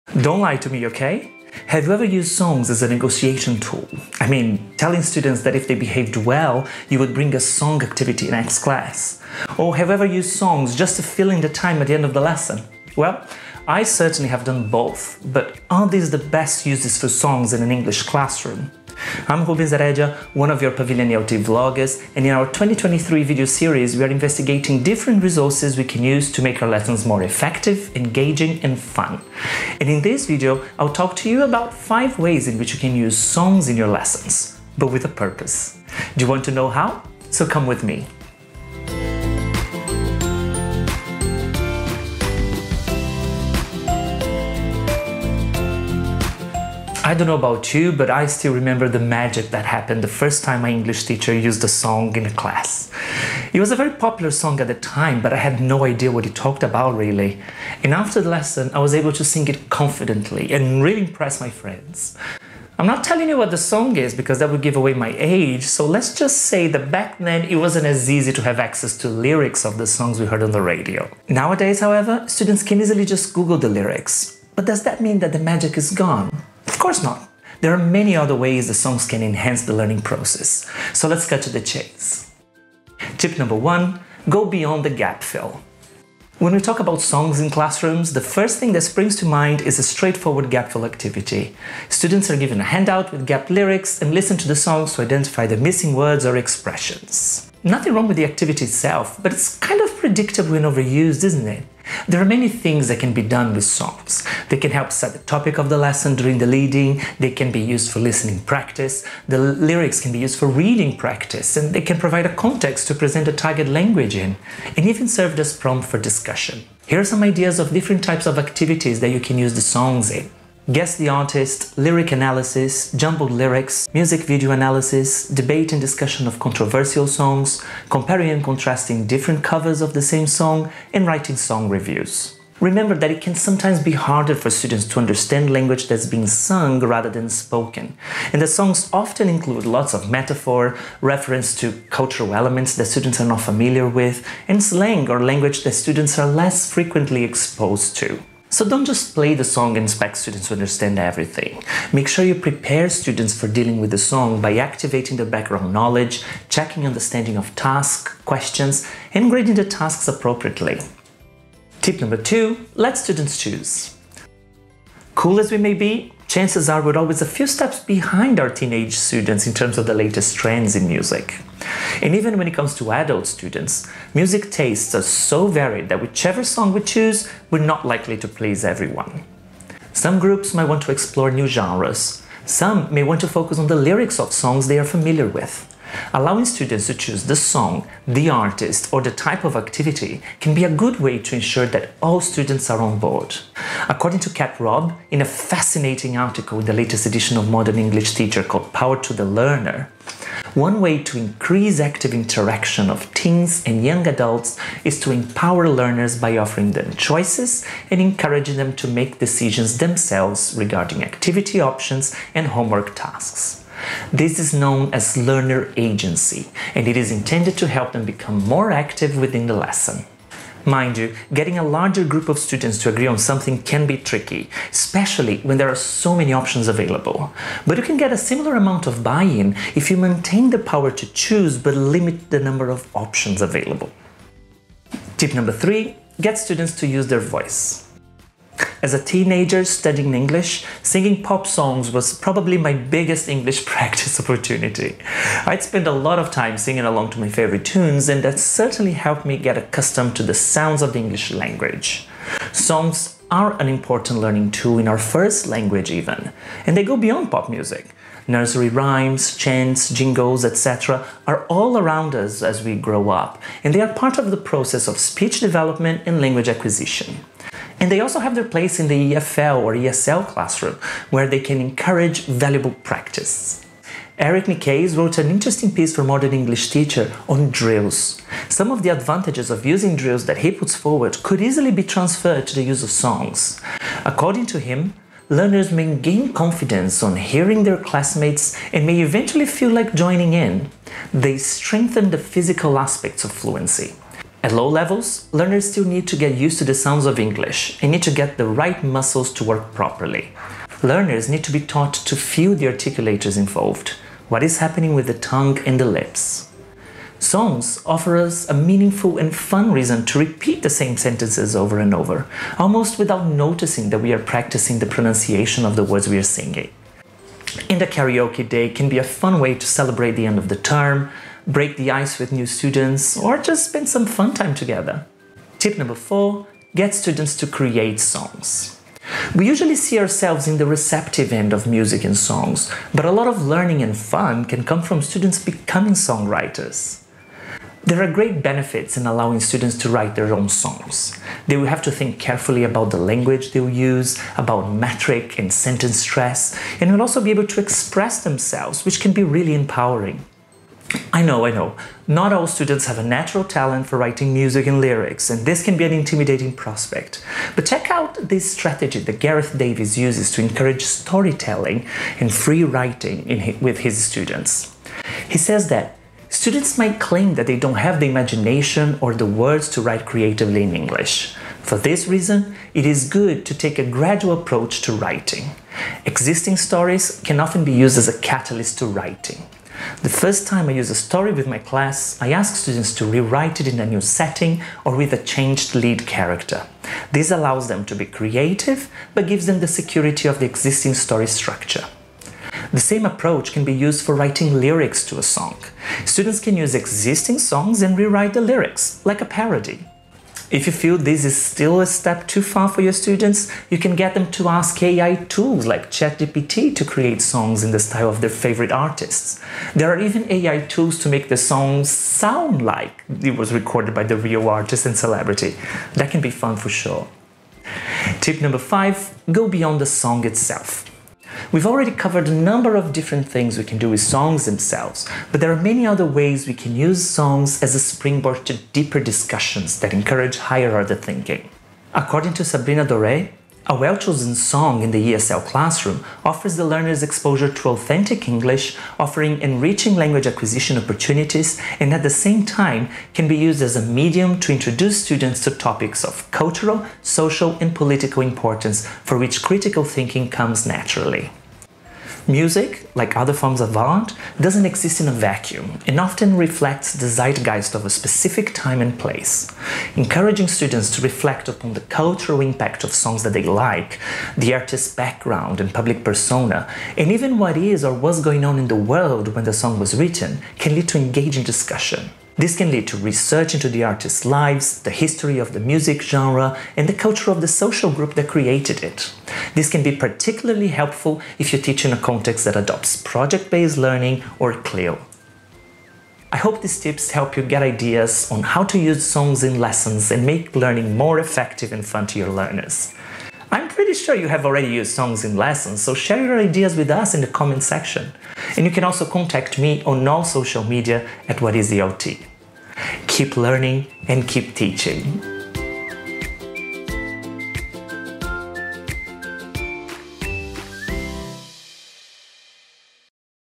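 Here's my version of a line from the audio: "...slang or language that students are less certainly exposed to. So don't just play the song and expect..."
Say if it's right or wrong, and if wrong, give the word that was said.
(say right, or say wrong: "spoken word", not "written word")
wrong: "frequently", not "certainly".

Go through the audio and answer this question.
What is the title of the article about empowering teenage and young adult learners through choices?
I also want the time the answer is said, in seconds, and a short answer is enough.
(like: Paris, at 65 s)
Power to the Learner, at 198 s.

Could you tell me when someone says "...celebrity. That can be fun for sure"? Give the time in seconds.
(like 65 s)
414 s.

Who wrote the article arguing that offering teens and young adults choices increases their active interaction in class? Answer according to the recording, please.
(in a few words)
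Kat Robb.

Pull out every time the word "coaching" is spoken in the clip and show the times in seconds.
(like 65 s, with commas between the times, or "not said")
not said.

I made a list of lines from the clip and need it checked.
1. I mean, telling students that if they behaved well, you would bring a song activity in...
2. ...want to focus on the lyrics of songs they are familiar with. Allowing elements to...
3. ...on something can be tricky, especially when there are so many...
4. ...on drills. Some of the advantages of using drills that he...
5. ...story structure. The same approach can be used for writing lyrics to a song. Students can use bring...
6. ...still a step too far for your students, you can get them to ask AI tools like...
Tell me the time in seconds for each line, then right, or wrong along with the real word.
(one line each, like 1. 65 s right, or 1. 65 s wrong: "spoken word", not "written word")
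1. 4 s right
2. 183 s wrong: "students", not "elements"
3. 223 s right
4. 277 s right
5. 390 s wrong: "existing", not "bring"
6. 401 s right.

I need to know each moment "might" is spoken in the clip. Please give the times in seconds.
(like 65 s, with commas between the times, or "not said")
180 s, 366 s.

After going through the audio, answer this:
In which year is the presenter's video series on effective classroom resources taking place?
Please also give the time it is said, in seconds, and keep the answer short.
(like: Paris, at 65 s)
2023, at 22 s.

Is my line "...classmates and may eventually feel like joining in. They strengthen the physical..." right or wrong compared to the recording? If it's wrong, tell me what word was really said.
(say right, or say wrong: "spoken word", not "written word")
right.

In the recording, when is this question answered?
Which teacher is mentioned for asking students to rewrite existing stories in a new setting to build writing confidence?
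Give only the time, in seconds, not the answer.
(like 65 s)
359 s.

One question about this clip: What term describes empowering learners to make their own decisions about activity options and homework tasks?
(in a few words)
learner agency.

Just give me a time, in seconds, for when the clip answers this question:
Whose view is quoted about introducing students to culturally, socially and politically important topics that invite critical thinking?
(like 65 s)
432 s.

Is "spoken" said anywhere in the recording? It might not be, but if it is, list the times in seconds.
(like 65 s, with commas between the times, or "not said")
137 s.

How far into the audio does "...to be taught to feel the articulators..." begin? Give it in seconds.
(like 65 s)
301 s.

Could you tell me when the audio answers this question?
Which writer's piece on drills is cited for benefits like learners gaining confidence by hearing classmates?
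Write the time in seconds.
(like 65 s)
274 s.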